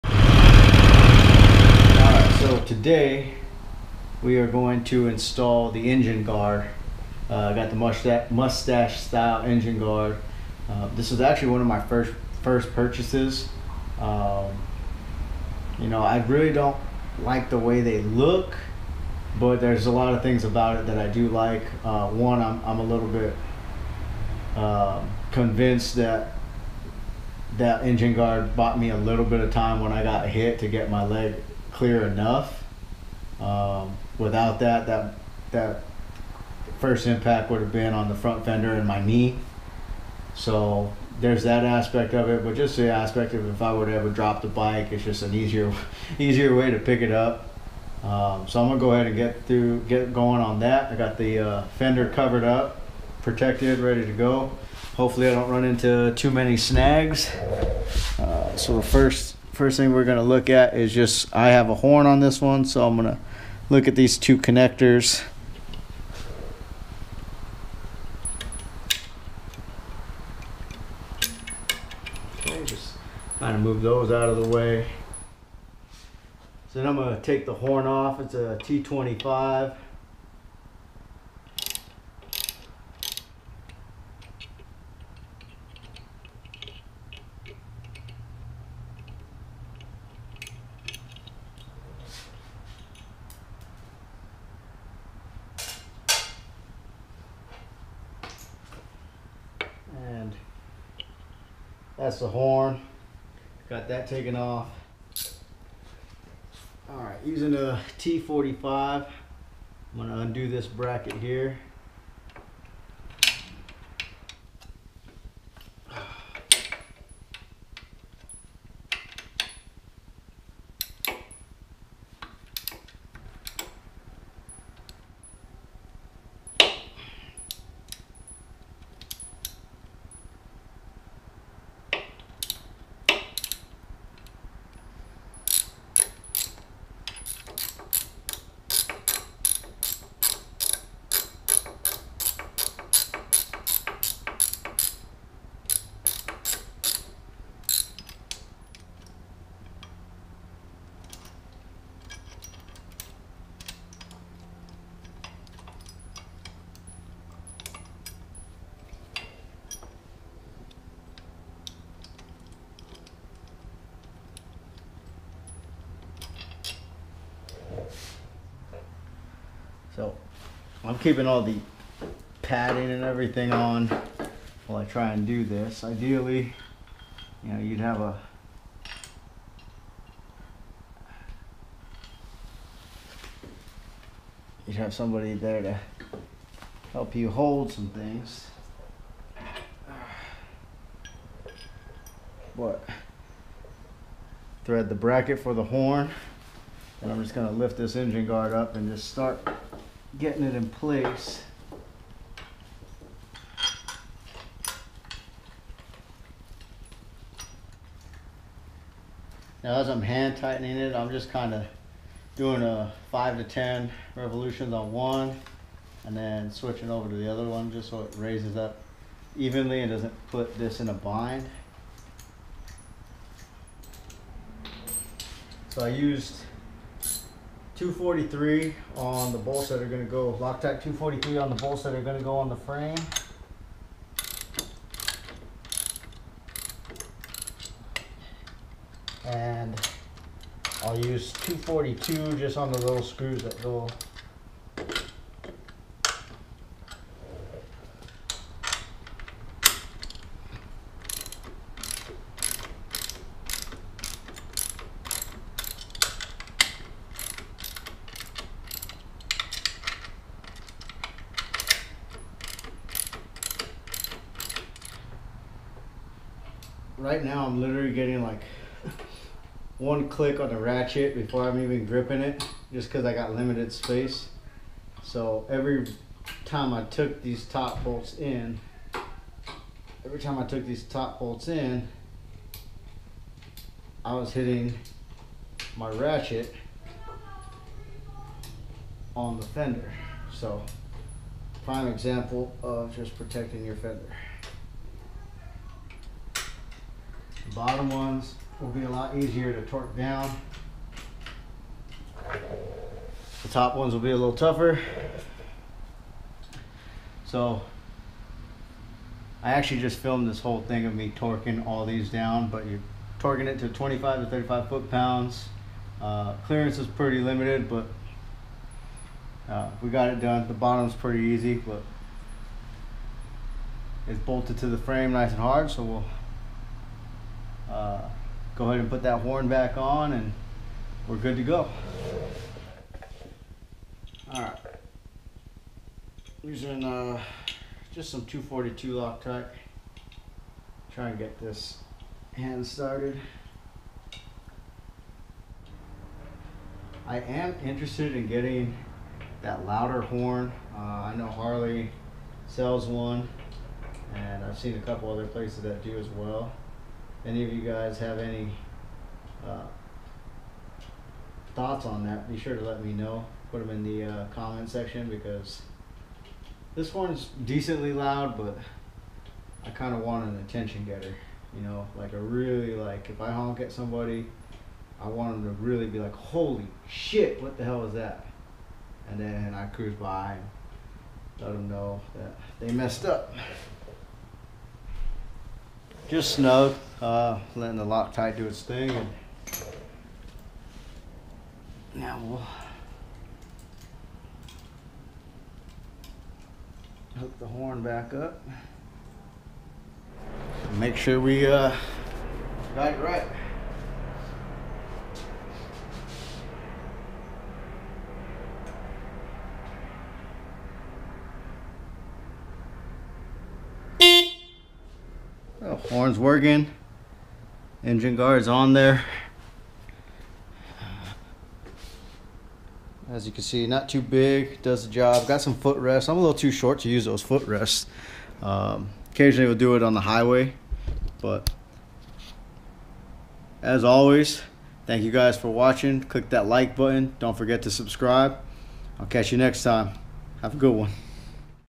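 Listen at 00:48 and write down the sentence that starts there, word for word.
Um, so I'm gonna go ahead and get through, get going on that.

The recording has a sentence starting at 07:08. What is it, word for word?
Um, occasionally we'll do it on the highway, but as always, thank you guys for watching.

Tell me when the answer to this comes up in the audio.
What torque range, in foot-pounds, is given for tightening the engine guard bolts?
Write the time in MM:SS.
05:13.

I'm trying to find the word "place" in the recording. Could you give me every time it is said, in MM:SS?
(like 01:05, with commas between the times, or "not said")
03:20, 05:55.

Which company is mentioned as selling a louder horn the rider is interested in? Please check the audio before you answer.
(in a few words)
Harley.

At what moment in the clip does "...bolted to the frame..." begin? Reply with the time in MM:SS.
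05:24.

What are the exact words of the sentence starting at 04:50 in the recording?
So prime example of just protecting your fender.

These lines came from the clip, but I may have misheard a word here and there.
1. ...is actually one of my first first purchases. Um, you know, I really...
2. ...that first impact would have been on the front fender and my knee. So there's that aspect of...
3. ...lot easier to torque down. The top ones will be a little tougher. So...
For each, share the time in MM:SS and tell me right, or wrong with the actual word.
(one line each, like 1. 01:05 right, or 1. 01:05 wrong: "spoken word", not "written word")
1. 00:11 right
2. 00:35 right
3. 04:58 right.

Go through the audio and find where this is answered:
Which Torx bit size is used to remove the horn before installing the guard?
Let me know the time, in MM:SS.
01:18.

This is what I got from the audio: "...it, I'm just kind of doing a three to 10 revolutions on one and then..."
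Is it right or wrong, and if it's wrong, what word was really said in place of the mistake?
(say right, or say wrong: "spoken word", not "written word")
wrong: "five", not "three".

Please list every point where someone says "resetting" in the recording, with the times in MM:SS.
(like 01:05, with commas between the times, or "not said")
not said.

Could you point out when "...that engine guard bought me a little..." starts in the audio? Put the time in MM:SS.
00:27.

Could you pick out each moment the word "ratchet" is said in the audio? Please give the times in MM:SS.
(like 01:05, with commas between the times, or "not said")
04:30, 04:45.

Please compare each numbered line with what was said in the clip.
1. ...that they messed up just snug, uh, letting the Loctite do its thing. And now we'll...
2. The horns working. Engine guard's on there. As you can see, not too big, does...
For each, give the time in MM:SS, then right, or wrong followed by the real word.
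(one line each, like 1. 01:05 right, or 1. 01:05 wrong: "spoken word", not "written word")
1. 06:22 right
2. 06:55 right.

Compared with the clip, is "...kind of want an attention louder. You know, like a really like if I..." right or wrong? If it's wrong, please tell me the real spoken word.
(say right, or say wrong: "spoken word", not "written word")
wrong: "getter", not "louder".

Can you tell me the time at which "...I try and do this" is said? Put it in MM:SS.
02:54.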